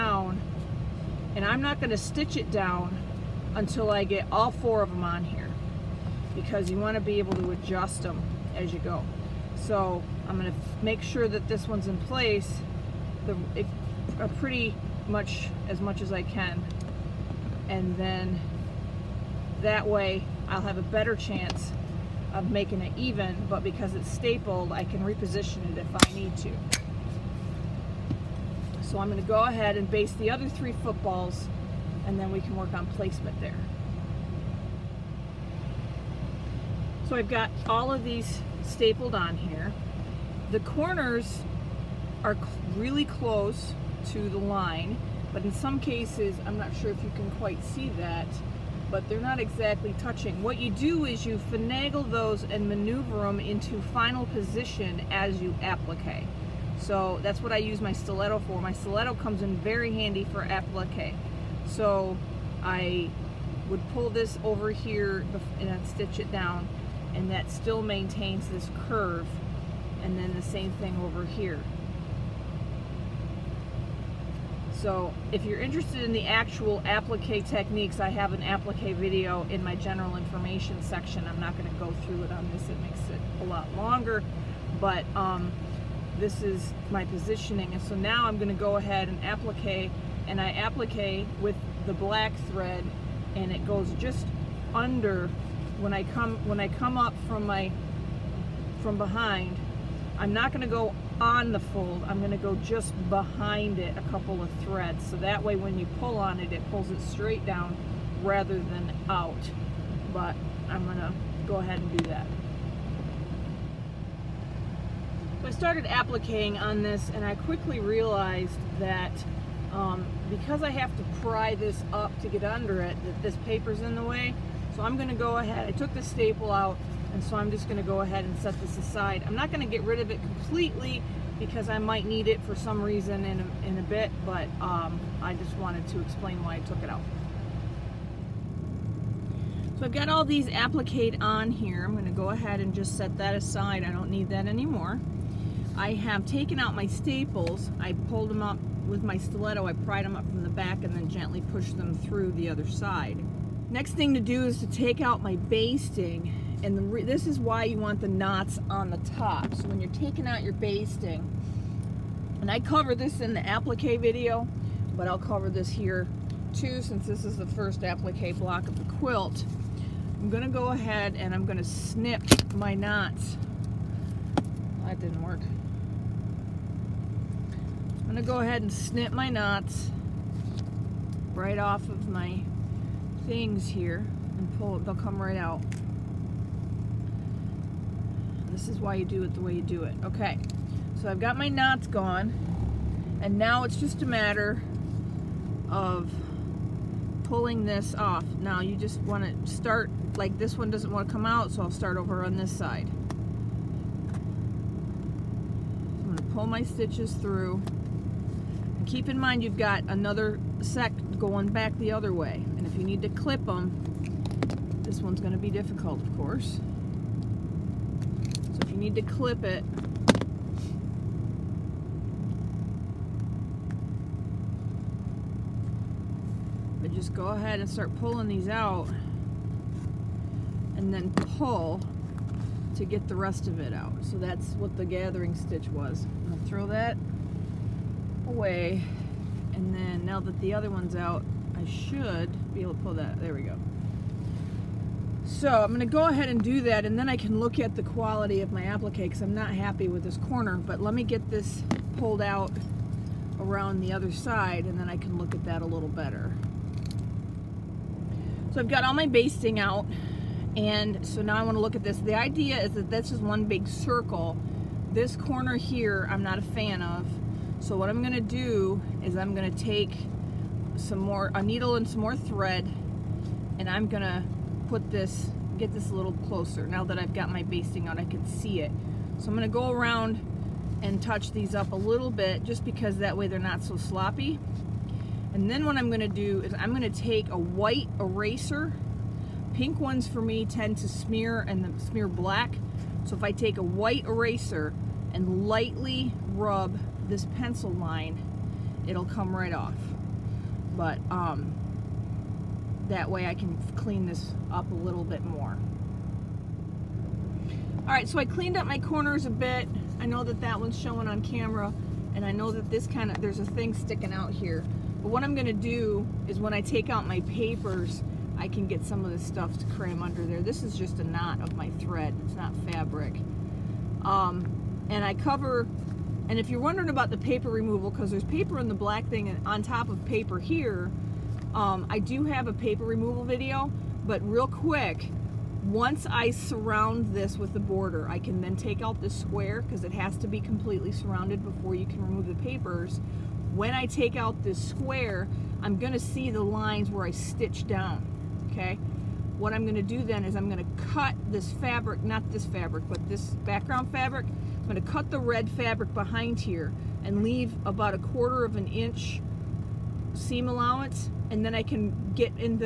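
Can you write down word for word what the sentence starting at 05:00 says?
But um, that way I can clean this up a little bit more.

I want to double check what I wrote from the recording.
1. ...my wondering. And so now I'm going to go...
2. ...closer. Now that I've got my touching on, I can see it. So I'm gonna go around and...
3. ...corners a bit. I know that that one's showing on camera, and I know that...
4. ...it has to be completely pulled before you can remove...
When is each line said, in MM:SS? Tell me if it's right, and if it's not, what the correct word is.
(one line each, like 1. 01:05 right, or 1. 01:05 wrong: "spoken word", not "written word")
1. 01:26 wrong: "positioning", not "wondering"
2. 04:36 wrong: "basting", not "touching"
3. 05:08 right
4. 05:39 wrong: "surrounded", not "pulled".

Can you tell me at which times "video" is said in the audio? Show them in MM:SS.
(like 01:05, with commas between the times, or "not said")
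01:18, 02:43, 05:33.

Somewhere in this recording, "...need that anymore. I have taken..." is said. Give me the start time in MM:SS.
02:24.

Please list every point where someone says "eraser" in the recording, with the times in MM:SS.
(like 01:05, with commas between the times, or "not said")
04:47, 04:54.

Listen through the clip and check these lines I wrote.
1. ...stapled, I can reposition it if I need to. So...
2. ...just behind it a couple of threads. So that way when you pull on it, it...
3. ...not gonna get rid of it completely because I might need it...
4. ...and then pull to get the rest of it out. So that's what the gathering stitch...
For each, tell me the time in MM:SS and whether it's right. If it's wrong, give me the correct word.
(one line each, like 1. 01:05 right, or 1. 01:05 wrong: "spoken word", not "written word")
1. 00:24 right
2. 01:42 right
3. 02:09 right
4. 03:50 right.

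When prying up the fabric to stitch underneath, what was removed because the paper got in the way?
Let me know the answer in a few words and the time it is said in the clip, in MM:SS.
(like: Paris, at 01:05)
the staple, at 02:06.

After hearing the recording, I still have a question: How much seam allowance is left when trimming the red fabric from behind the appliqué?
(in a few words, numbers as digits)
a quarter of an inch.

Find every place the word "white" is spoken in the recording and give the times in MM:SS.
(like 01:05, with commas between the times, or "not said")
04:47, 04:53.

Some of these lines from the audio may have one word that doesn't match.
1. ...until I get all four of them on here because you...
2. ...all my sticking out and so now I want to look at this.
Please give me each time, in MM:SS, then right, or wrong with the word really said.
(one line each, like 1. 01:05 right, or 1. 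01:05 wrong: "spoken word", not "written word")
1. 00:03 right
2. 04:18 wrong: "basting", not "sticking".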